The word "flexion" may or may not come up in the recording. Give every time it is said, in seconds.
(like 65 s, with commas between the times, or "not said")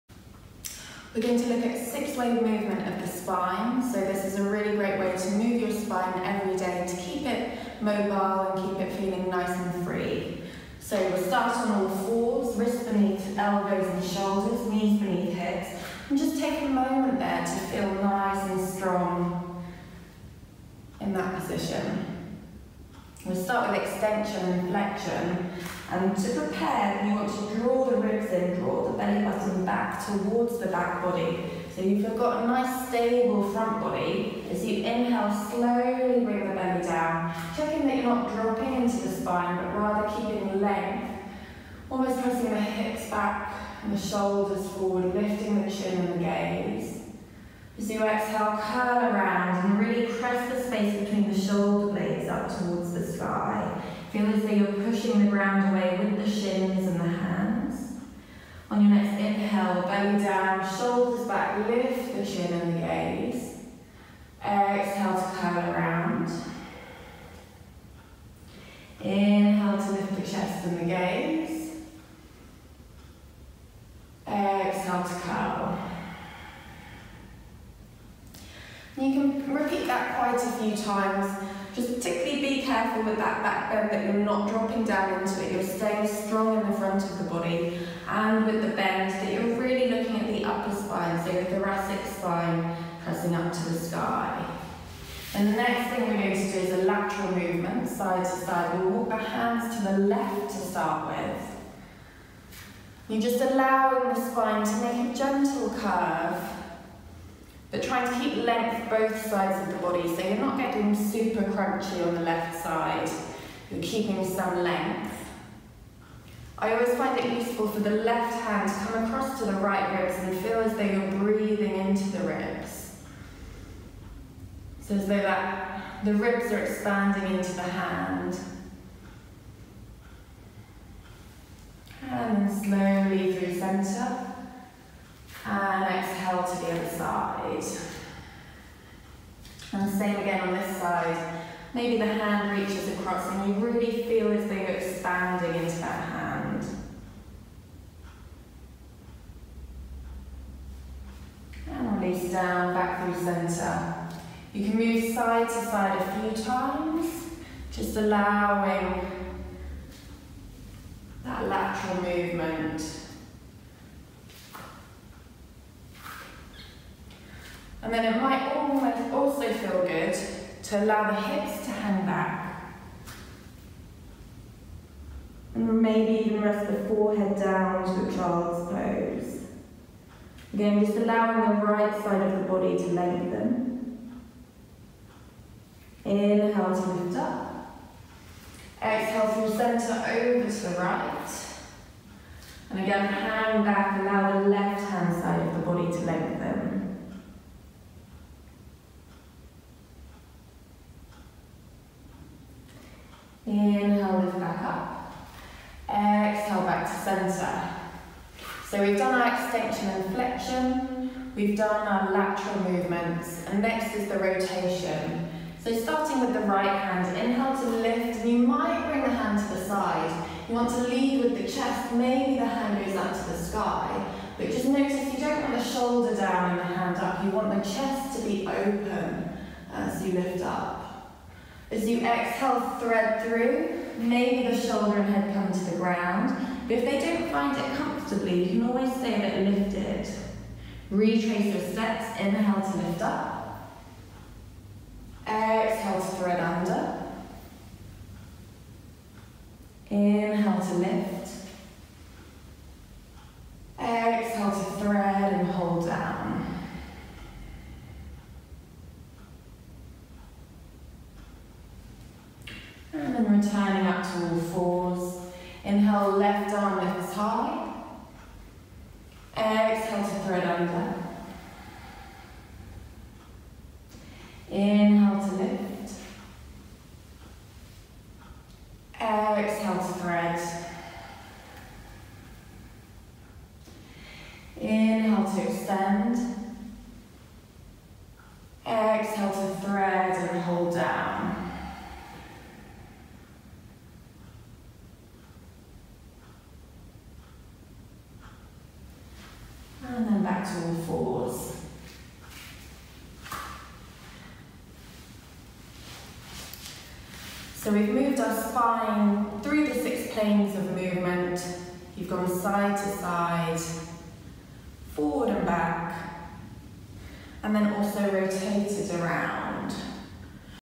24 s, 210 s.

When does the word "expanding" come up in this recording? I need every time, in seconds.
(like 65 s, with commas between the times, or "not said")
126 s, 144 s.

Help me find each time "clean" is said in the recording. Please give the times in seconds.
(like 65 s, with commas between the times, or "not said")
not said.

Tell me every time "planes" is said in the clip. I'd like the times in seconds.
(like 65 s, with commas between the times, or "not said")
310 s.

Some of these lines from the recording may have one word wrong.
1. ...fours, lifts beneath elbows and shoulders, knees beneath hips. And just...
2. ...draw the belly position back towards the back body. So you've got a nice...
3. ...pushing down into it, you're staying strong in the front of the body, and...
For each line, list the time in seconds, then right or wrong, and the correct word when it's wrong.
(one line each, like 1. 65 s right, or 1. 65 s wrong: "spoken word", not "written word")
1. 11 s wrong: "wrists", not "lifts"
2. 28 s wrong: "button", not "position"
3. 84 s wrong: "dropping", not "pushing".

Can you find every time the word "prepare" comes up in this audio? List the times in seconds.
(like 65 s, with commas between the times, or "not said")
26 s.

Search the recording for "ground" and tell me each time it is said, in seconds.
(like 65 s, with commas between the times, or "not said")
55 s, 235 s.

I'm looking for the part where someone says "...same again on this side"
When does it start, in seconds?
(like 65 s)
139 s.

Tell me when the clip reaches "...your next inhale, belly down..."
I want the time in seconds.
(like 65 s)
58 s.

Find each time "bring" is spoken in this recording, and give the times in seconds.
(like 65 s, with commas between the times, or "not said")
36 s, 218 s.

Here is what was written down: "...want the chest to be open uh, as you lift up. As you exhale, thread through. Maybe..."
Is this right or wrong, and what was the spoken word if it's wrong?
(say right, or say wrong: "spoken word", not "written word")
right.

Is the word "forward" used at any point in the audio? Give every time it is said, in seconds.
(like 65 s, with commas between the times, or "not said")
44 s, 314 s.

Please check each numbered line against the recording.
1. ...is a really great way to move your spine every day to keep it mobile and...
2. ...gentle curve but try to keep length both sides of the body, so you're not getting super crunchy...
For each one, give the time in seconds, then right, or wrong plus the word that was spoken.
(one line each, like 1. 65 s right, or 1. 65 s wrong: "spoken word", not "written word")
1. 4 s right
2. 105 s right.